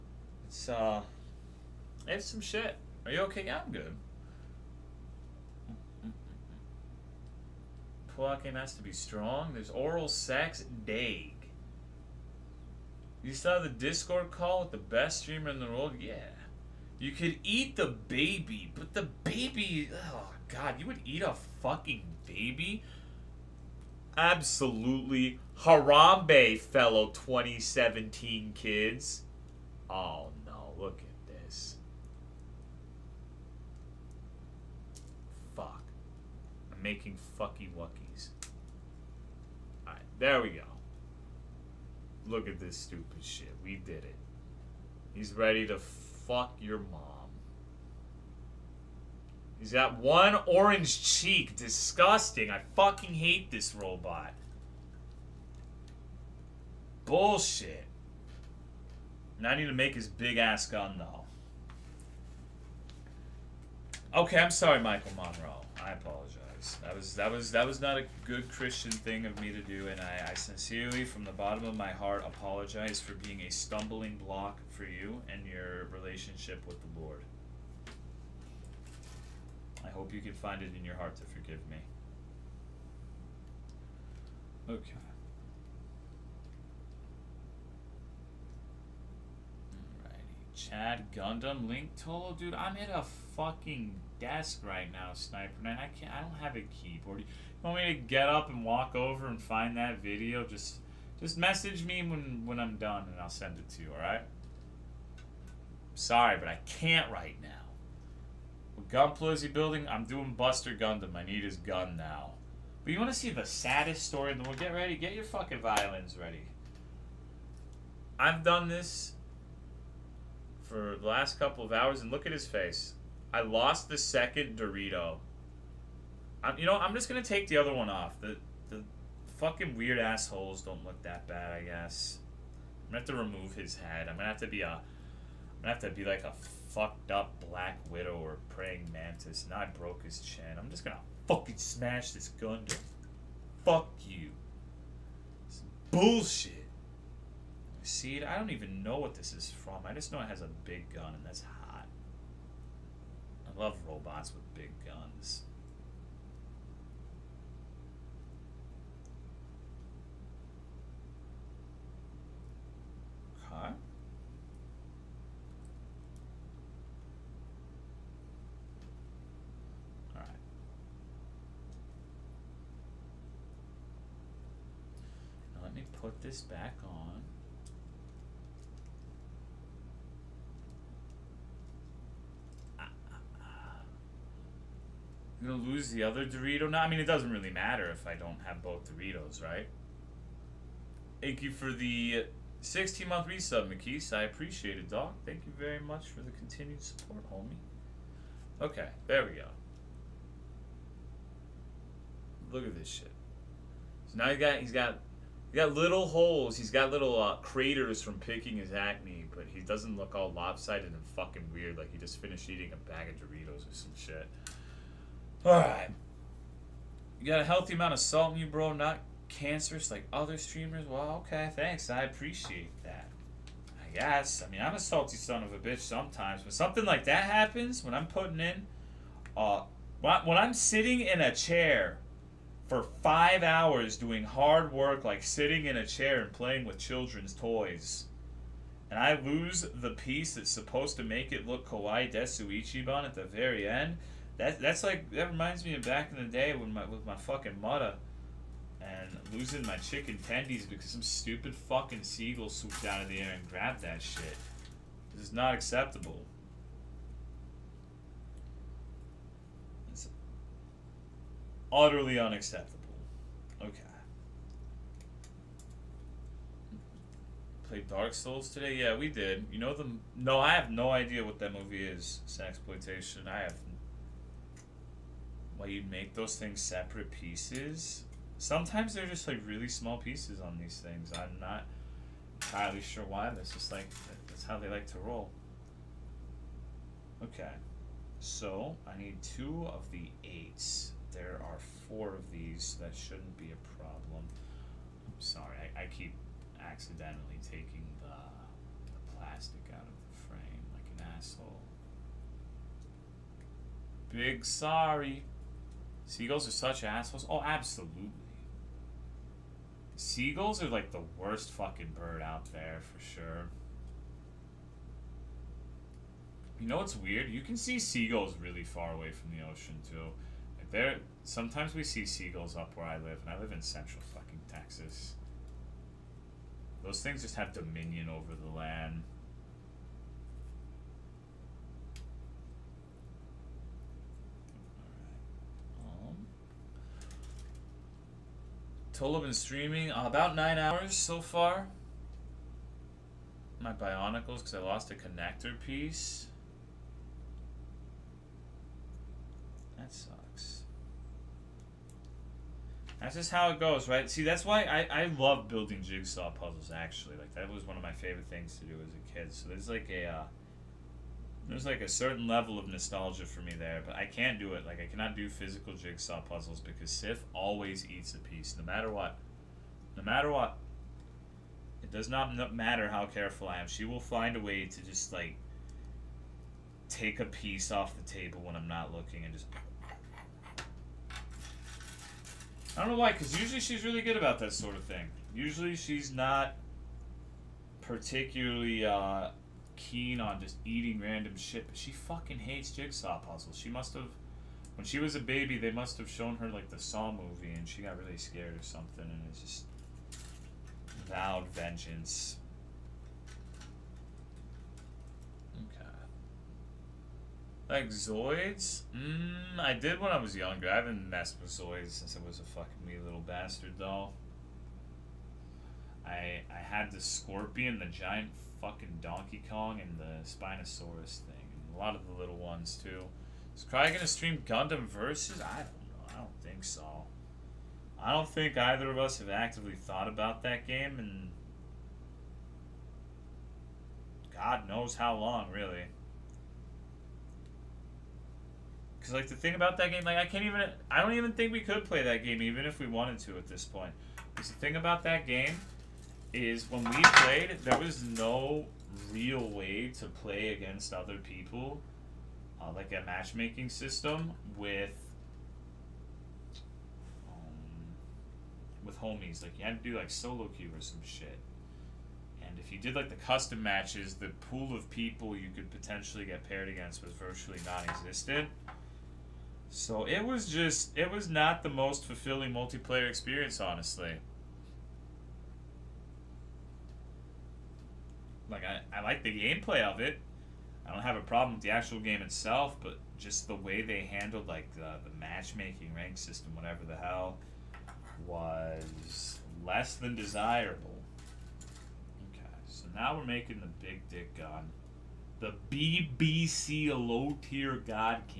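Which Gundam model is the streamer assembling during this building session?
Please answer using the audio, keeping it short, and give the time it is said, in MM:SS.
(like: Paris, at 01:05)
Buster Gundam, at 01:50.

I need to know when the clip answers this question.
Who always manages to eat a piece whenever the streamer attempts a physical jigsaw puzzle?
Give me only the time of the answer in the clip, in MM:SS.
06:06.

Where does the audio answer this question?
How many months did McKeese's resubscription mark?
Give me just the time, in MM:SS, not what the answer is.
03:12.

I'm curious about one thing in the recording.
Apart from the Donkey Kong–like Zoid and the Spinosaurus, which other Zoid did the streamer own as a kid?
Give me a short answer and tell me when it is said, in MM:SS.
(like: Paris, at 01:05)
The scorpion, at 06:56.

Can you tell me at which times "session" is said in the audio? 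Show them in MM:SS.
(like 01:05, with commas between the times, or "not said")
not said.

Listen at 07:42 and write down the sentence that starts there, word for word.
And if you did like the custom matches, the pool of people you could potentially get paired against was virtually non-existent.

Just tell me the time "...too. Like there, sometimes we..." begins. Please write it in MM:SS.
05:19.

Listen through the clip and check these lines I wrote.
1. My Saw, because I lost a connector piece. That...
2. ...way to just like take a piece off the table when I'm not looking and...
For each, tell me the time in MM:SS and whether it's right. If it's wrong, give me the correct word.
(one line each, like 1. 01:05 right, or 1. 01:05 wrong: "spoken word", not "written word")
1. 05:43 wrong: "Bionicles", not "Saw"
2. 06:14 right.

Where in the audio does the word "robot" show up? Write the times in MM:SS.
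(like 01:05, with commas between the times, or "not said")
00:53, 02:33.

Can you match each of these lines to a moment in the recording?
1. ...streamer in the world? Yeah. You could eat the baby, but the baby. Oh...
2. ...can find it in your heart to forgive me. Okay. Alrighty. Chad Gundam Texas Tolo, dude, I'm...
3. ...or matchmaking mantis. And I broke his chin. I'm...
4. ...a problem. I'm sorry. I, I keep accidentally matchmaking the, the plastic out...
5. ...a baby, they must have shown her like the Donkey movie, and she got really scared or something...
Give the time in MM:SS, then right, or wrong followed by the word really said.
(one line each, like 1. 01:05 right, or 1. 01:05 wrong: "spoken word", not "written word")
1. 00:15 right
2. 01:20 wrong: "Link", not "Texas"
3. 02:18 wrong: "praying", not "matchmaking"
4. 04:53 wrong: "taking", not "matchmaking"
5. 06:35 wrong: "Saw", not "Donkey".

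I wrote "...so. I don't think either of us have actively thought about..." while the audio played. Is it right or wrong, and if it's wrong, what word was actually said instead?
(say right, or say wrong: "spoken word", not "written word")
right.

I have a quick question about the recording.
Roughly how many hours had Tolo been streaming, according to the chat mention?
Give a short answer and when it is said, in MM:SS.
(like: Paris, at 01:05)
9, at 05:40.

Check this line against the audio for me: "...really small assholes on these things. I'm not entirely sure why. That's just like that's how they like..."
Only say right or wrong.
wrong.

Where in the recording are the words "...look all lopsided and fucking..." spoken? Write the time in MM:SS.
03:29.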